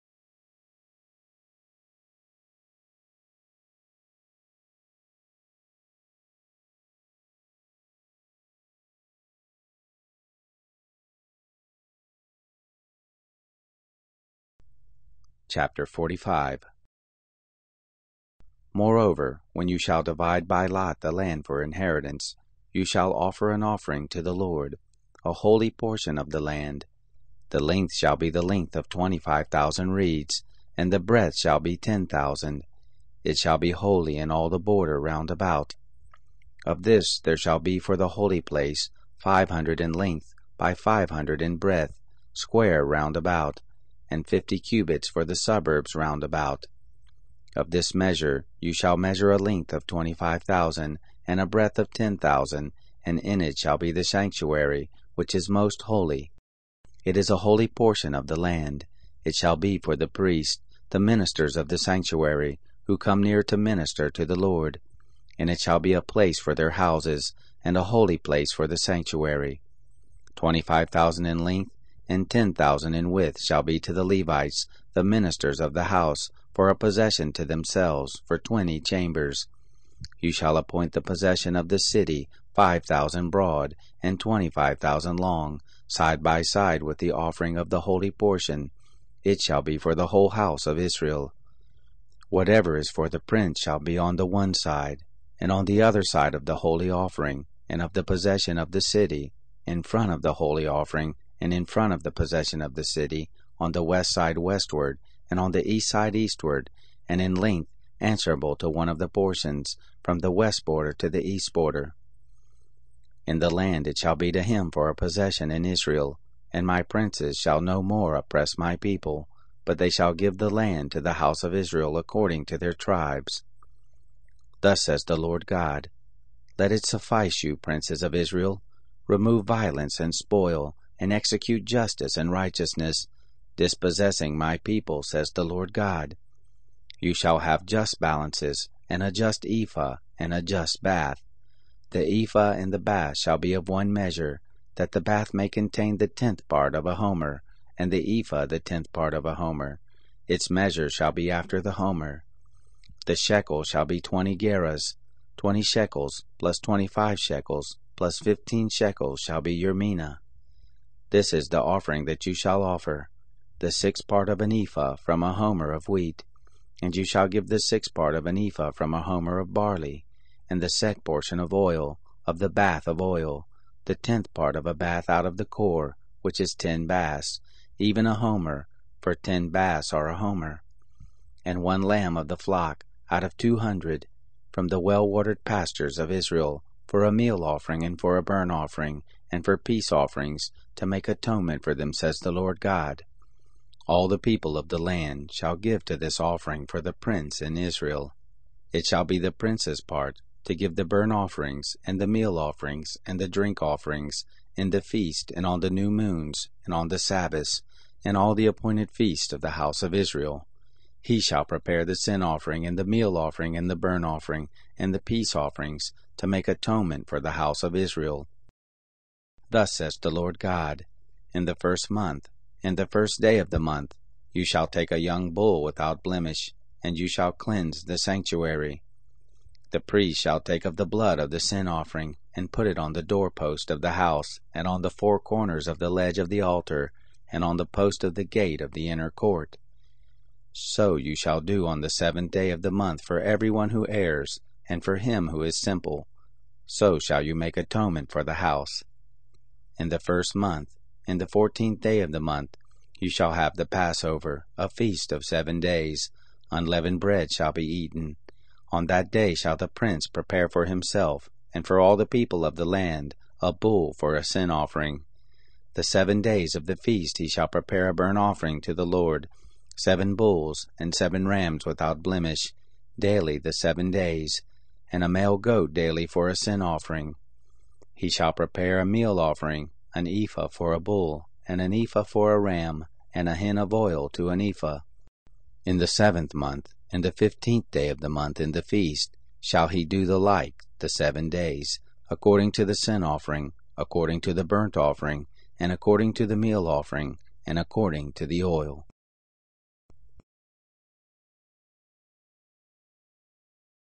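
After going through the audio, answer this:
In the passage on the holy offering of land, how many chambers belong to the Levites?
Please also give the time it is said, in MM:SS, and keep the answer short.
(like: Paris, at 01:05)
20, at 01:18.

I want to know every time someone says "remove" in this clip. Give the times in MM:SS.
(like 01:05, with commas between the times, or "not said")
02:09.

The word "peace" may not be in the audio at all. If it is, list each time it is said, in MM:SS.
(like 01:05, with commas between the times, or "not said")
03:09, 03:34.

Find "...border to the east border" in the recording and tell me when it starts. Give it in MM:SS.
01:50.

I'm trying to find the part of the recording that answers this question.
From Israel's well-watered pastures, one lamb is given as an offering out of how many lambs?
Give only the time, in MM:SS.
03:03.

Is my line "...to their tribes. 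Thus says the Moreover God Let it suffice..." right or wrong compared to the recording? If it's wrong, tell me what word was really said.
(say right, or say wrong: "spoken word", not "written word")
wrong: "Lord", not "Moreover".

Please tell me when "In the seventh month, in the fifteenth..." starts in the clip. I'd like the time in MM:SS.
04:45.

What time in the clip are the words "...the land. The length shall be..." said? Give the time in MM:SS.
00:26.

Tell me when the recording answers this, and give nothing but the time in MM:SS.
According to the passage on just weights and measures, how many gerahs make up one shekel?
02:33.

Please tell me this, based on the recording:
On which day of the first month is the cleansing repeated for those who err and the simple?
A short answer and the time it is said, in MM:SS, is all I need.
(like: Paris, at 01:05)
7th day, at 04:01.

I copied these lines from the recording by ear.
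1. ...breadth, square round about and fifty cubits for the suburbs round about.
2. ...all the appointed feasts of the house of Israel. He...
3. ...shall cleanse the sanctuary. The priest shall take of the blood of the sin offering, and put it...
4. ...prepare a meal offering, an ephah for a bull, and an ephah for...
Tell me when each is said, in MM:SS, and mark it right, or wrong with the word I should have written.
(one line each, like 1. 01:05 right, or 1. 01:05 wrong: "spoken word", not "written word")
1. 00:41 right
2. 03:28 right
3. 03:47 right
4. 04:38 right.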